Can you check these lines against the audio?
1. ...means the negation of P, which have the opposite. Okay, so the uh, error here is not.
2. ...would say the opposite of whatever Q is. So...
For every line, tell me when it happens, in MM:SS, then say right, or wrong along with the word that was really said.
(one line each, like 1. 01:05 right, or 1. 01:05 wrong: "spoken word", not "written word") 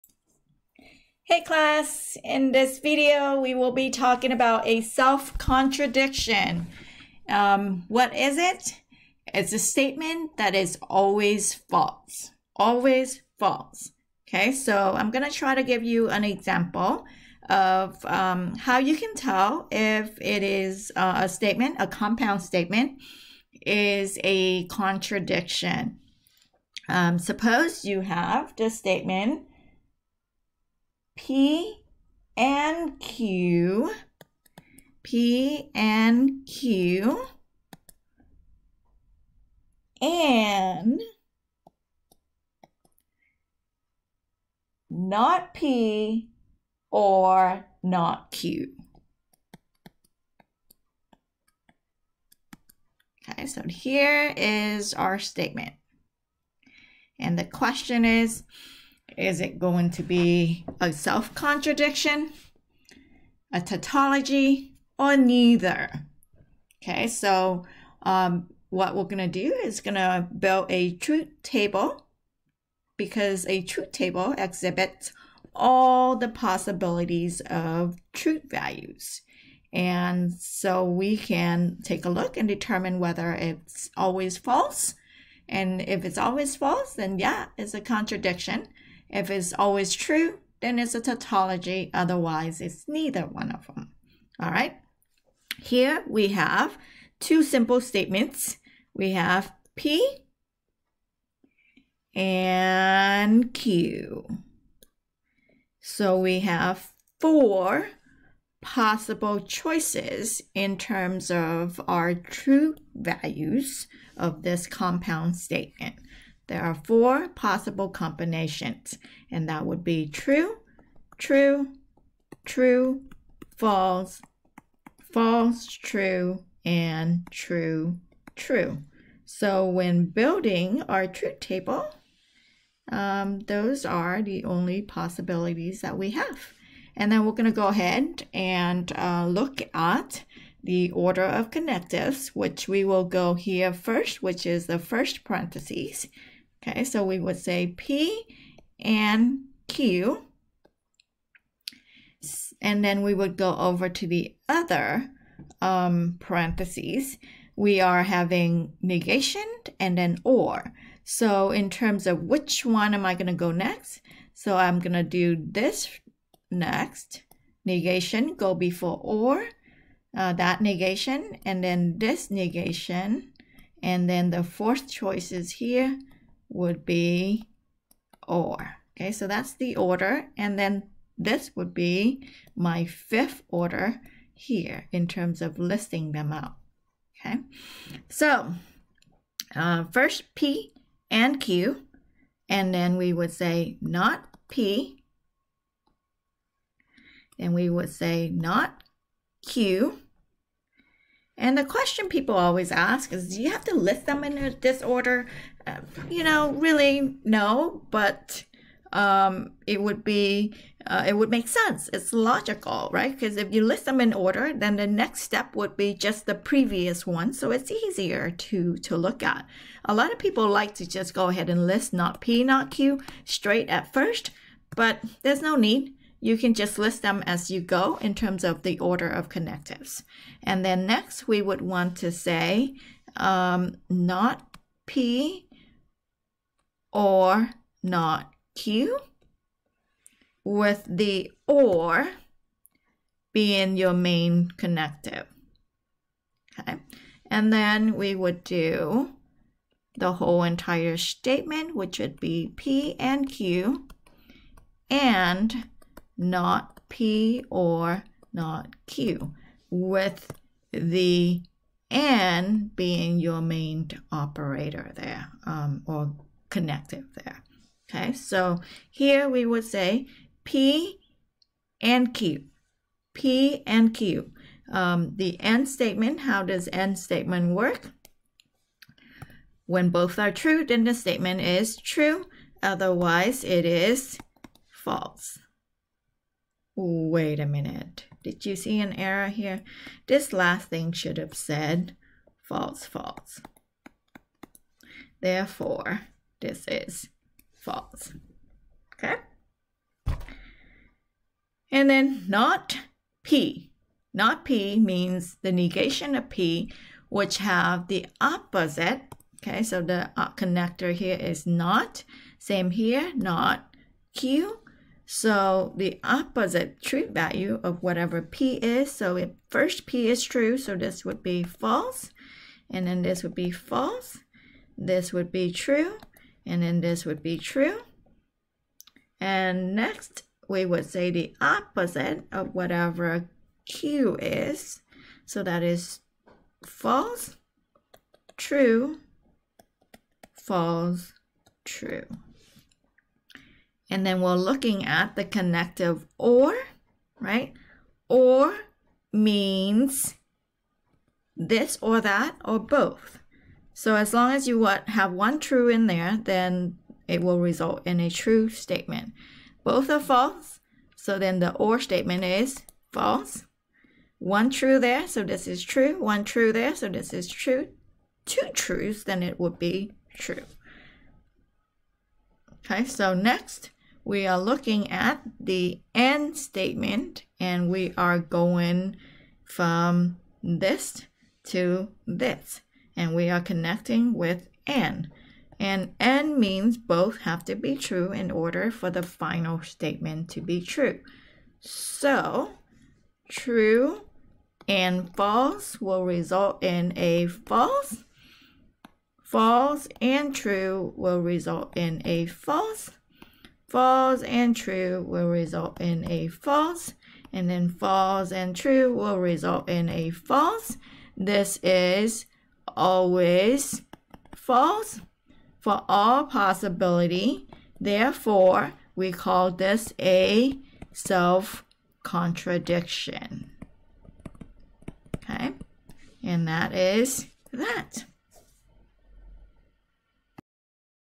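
1. 05:04 wrong: "connector", not "error"
2. 05:30 right.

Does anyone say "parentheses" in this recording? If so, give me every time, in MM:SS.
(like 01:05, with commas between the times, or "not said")
02:25, 02:36.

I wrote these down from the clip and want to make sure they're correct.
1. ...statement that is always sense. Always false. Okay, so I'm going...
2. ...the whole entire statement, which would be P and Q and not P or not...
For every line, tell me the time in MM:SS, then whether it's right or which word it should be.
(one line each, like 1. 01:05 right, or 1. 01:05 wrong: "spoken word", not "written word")
1. 00:09 wrong: "false", not "sense"
2. 04:09 right.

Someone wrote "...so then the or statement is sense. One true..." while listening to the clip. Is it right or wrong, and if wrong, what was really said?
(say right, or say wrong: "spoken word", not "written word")
wrong: "false", not "sense".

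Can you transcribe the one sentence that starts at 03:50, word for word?
And then next, we would want to say um, not P or not Q with the or being your main connective.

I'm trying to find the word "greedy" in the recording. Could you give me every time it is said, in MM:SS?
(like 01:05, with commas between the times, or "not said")
not said.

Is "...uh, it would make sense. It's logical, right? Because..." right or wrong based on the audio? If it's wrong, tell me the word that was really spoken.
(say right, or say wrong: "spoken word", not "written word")
right.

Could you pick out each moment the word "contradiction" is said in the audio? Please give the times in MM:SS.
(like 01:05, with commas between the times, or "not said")
00:04, 00:24, 01:01, 01:27, 07:02.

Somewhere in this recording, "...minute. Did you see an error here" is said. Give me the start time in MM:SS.
04:47.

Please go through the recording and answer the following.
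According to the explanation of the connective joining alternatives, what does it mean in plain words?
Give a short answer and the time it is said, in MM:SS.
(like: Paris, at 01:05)
this or that or both, at 05:51.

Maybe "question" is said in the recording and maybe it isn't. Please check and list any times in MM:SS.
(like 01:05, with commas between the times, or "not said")
00:57, 03:21.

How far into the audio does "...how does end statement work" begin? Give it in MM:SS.
04:36.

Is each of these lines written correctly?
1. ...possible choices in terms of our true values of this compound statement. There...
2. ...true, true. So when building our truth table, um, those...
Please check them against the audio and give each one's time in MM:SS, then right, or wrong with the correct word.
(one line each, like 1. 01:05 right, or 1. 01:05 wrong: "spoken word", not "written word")
1. 01:48 right
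2. 02:07 right.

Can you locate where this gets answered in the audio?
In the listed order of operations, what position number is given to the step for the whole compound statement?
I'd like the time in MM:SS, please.
03:02.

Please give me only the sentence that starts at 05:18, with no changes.
So if first P is true, so this would be false.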